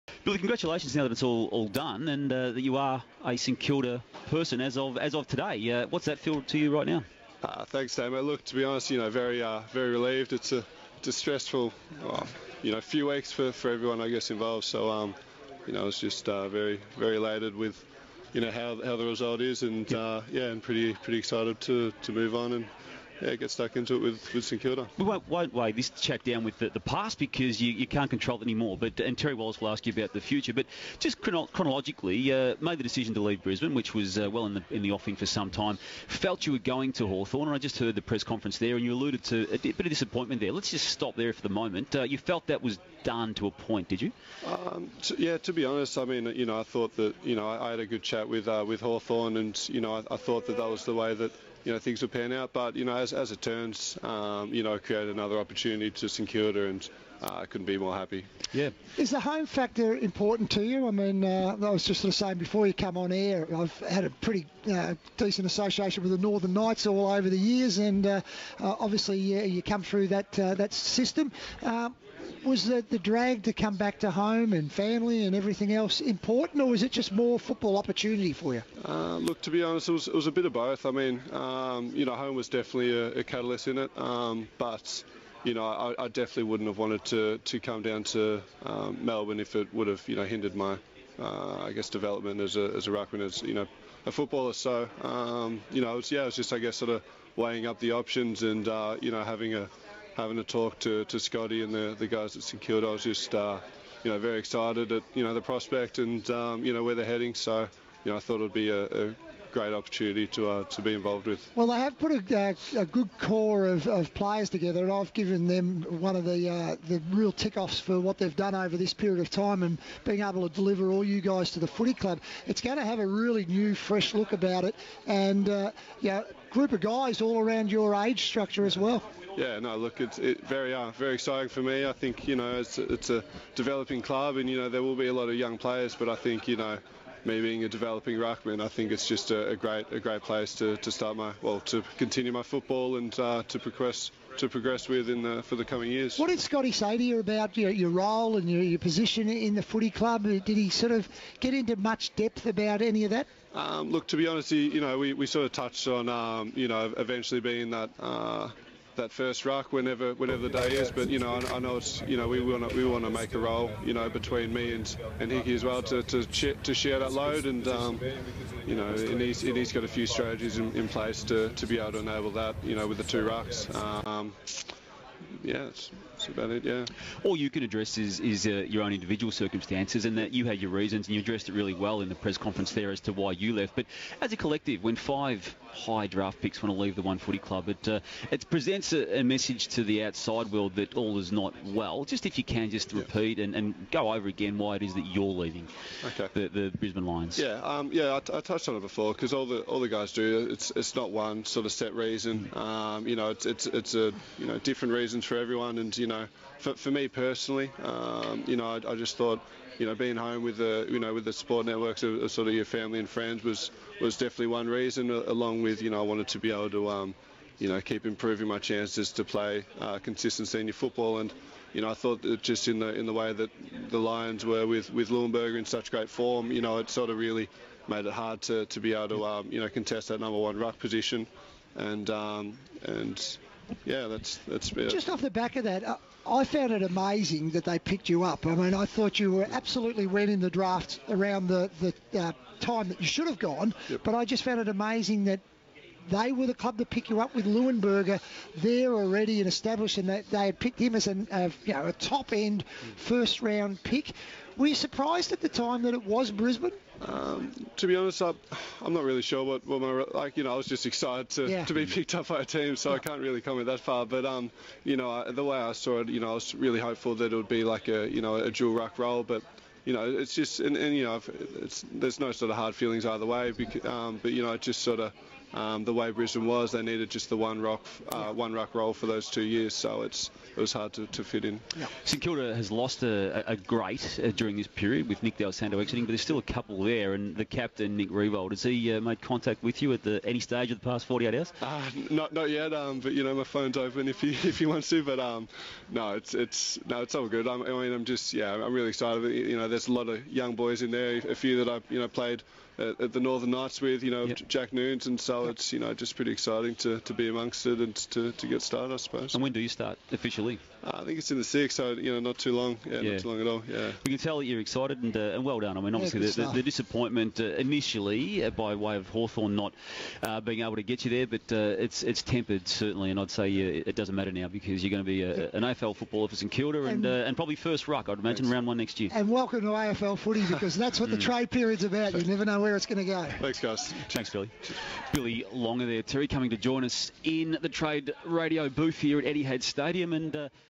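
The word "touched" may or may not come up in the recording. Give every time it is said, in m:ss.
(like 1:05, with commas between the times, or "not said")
2:35, 3:18.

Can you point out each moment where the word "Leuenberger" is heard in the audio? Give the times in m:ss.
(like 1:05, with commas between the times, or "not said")
3:45, 4:07.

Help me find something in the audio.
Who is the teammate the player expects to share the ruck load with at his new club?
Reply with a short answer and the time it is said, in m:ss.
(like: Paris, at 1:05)
Hickey, at 2:45.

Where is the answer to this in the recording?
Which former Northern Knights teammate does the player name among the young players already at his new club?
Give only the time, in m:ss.
5:04.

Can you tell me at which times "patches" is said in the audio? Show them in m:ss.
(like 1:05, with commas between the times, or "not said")
not said.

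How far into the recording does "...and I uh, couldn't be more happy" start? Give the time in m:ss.
0:56.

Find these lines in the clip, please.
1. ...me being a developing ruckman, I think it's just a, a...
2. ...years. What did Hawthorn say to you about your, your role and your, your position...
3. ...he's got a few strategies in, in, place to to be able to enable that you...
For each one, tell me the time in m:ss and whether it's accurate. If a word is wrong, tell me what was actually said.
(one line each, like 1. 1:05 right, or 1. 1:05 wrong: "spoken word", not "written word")
1. 2:17 right
2. 2:25 wrong: "Scotty", not "Hawthorn"
3. 2:49 right.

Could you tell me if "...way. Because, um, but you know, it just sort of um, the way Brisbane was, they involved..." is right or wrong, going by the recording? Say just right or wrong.
wrong.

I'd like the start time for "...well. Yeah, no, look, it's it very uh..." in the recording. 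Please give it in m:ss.
2:08.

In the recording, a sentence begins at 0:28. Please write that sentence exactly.
But and Terry Wallace will ask you about the future.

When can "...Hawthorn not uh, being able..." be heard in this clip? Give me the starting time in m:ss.
5:19.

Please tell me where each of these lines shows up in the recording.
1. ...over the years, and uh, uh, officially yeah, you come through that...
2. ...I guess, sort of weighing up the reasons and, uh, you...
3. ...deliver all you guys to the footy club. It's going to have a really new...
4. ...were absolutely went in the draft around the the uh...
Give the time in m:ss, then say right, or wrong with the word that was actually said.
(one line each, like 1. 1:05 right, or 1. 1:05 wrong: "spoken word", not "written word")
1. 1:07 wrong: "obviously", not "officially"
2. 1:36 wrong: "options", not "reasons"
3. 2:00 right
4. 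3:59 right.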